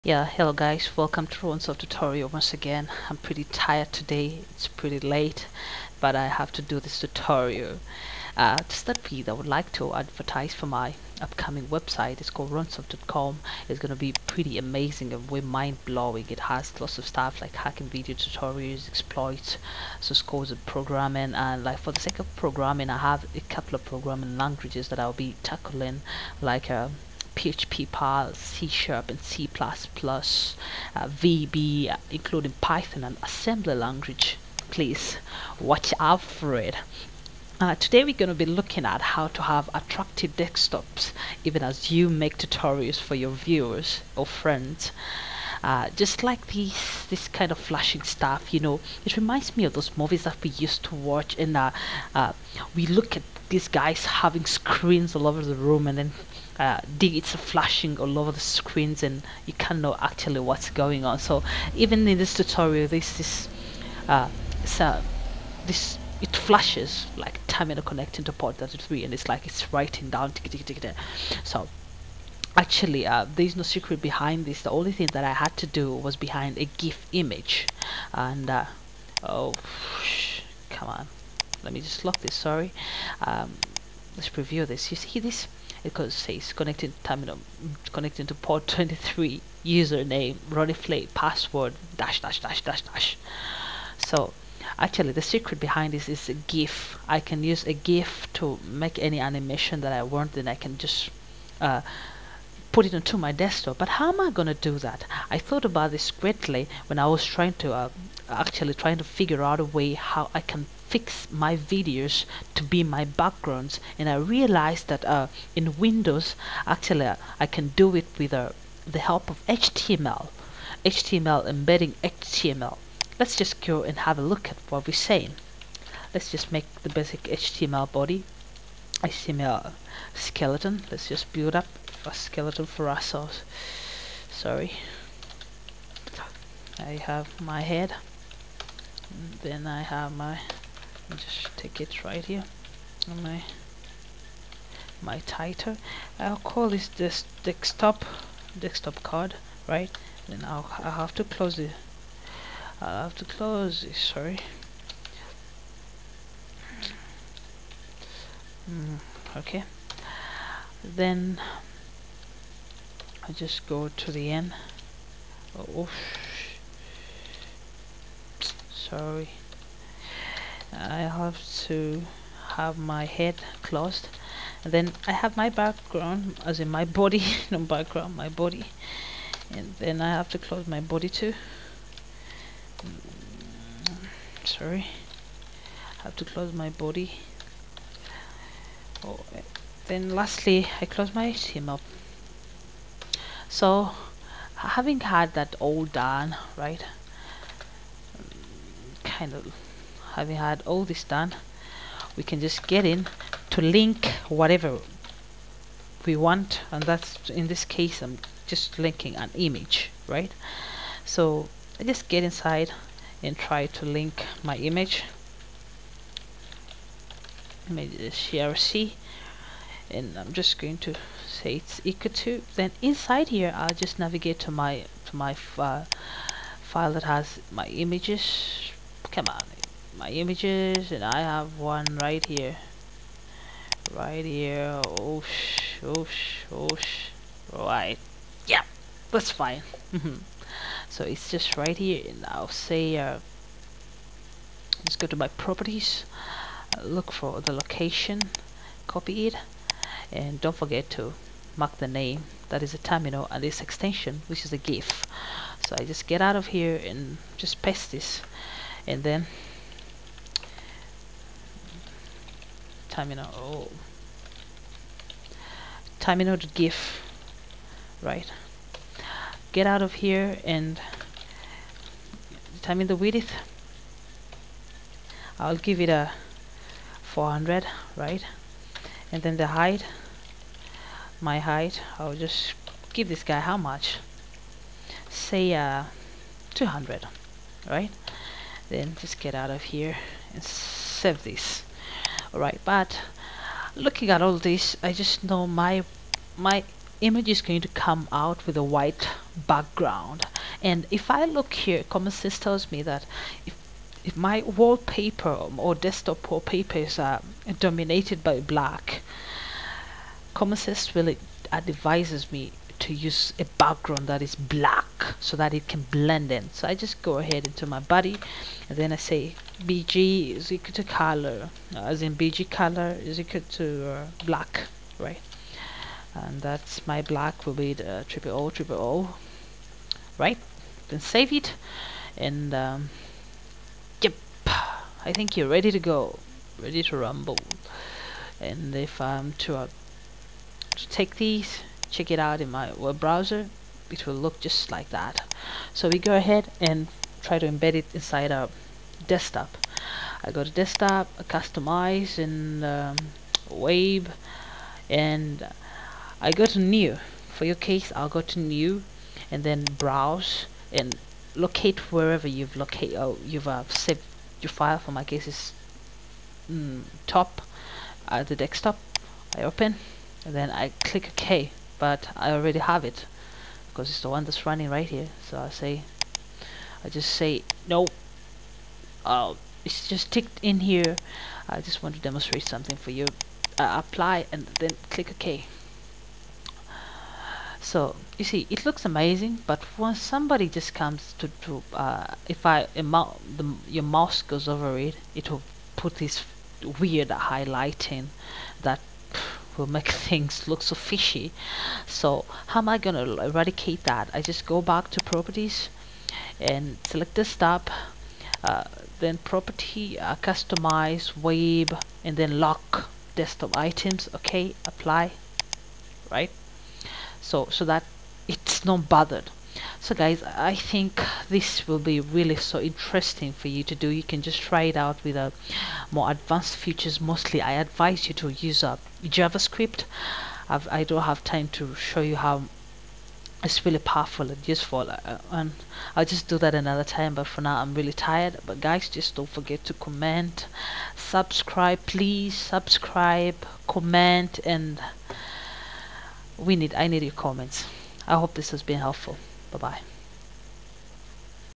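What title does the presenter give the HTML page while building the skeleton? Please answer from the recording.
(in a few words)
desktop card.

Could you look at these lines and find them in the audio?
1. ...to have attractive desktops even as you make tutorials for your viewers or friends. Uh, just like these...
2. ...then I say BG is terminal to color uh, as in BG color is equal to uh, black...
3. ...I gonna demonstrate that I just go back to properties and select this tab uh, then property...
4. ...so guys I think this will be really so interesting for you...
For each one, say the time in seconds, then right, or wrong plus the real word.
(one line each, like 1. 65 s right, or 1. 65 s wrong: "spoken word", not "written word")
1. 39 s right
2. 318 s wrong: "equal", not "terminal"
3. 402 s wrong: "eradicate", not "demonstrate"
4. 419 s right.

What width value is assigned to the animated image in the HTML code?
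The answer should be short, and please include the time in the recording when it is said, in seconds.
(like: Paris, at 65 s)
400, at 277 s.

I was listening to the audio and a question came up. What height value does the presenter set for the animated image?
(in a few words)
200.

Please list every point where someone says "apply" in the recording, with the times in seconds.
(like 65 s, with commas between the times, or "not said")
383 s, 414 s.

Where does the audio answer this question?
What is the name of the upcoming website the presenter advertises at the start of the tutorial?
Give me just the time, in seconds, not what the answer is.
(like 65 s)
12 s.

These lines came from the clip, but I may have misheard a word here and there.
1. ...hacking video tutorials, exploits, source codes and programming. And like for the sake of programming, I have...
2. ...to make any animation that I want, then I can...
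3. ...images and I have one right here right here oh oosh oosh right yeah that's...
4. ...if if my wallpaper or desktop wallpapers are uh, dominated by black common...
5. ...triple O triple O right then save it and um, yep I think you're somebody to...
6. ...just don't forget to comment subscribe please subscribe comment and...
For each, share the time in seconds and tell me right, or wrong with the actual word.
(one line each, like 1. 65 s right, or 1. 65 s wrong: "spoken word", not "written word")
1. 17 s right
2. 98 s right
3. 230 s right
4. 303 s right
5. 328 s wrong: "ready", not "somebody"
6. 438 s right.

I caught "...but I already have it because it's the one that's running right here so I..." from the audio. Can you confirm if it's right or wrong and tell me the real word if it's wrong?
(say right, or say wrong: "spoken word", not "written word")
right.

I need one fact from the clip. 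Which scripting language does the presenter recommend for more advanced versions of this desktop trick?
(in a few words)
JavaScript.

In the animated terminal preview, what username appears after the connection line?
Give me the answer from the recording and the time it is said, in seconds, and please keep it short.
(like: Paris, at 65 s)
Ronnie Flay, at 90 s.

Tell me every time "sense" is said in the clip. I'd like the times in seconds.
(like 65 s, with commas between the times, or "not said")
302 s, 310 s.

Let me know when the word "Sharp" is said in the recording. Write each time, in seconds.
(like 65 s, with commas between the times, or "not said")
28 s.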